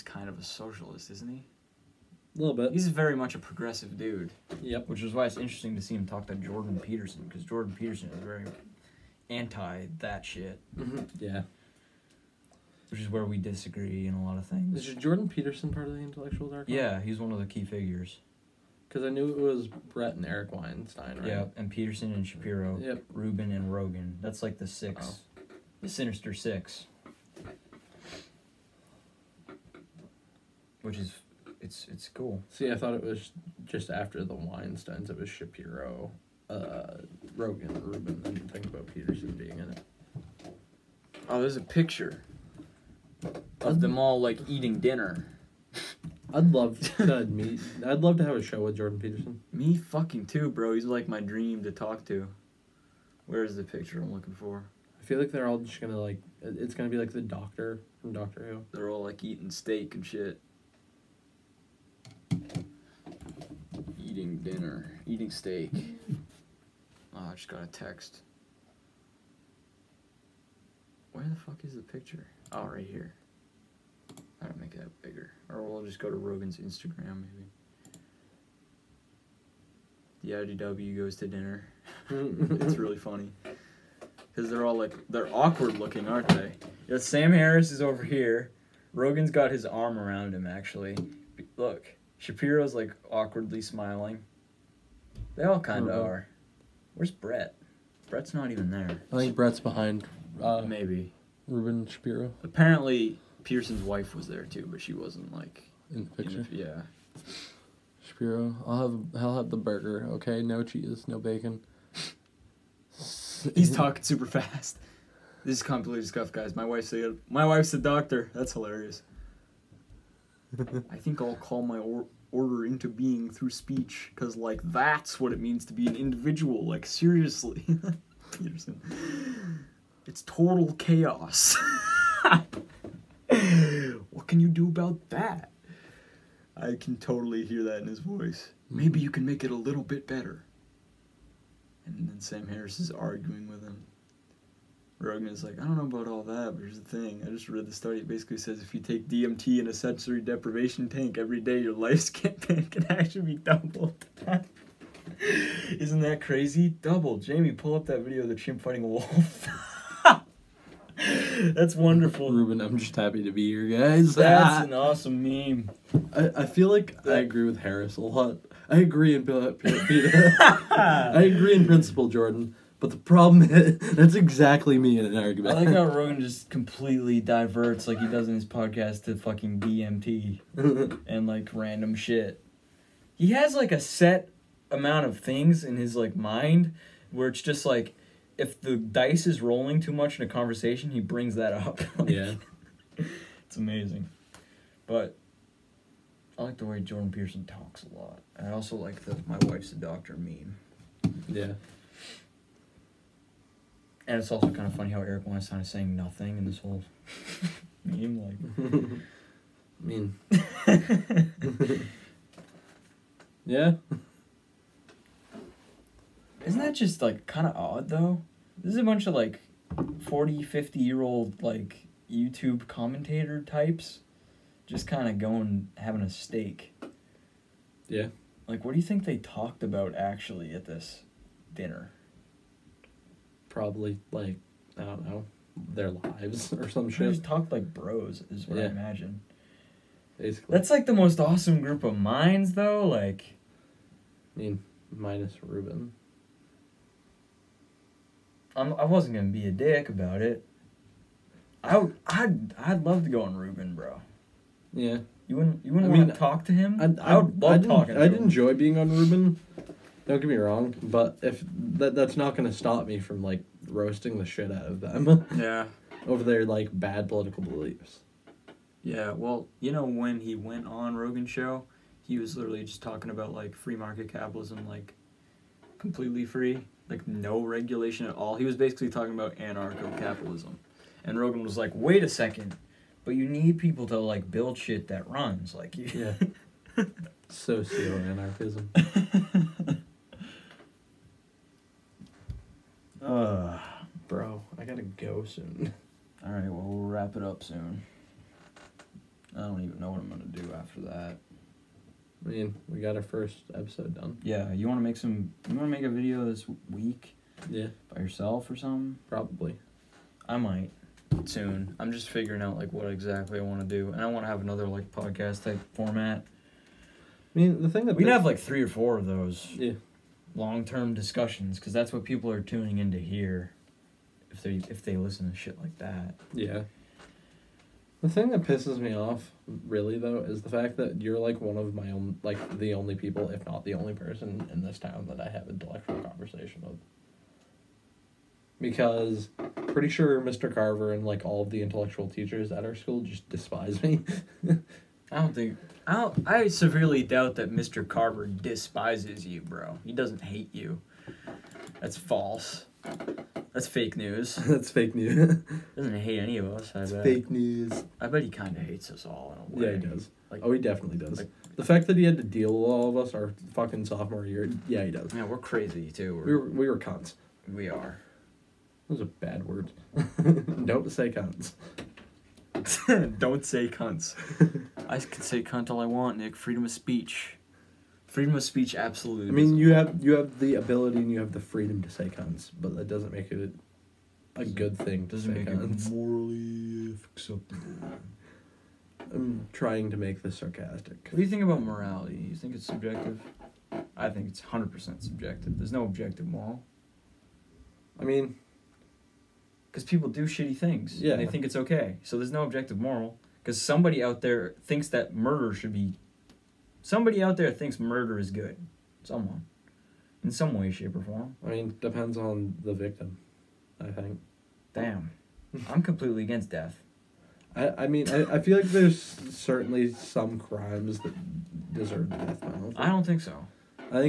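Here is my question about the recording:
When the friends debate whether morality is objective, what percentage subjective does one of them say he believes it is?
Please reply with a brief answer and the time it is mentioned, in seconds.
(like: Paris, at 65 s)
100 percent, at 394 s.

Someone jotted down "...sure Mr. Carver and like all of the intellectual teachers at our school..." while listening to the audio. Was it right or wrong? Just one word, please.
right.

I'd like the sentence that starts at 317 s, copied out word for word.
I mean, the thing that we can have like three or four of those.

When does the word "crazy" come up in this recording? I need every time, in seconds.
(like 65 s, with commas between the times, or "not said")
156 s, 365 s.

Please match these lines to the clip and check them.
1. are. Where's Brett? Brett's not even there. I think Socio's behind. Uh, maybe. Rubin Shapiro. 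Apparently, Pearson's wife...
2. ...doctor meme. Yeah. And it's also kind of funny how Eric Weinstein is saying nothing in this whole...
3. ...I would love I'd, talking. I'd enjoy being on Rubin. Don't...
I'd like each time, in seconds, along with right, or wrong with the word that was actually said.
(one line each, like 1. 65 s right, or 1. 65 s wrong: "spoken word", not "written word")
1. 96 s wrong: "Brett", not "Socio"
2. 199 s right
3. 257 s right.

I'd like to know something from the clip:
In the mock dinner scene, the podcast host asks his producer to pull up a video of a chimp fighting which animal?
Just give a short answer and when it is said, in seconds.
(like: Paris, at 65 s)
a wolf, at 158 s.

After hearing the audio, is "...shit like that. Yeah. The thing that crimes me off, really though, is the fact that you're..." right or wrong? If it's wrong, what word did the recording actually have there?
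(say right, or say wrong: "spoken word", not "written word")
wrong: "pisses", not "crimes".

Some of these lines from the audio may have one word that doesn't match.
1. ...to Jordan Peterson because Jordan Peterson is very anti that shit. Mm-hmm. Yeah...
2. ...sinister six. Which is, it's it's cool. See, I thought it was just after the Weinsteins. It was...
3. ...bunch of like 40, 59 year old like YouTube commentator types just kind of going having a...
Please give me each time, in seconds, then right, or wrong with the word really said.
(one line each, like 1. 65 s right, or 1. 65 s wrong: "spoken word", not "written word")
1. 6 s right
2. 25 s right
3. 218 s wrong: "50", not "59".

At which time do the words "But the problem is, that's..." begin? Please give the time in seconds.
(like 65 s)
172 s.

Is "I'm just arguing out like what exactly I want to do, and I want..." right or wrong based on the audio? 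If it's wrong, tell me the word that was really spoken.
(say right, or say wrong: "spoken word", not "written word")
wrong: "figuring", not "arguing".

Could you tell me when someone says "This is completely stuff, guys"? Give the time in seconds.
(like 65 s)
115 s.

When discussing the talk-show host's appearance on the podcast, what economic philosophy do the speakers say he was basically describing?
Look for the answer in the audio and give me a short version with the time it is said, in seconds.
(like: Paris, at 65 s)
anarcho capitalism, at 279 s.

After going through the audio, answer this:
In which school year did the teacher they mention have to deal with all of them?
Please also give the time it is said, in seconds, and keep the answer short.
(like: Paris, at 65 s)
sophomore year, at 363 s.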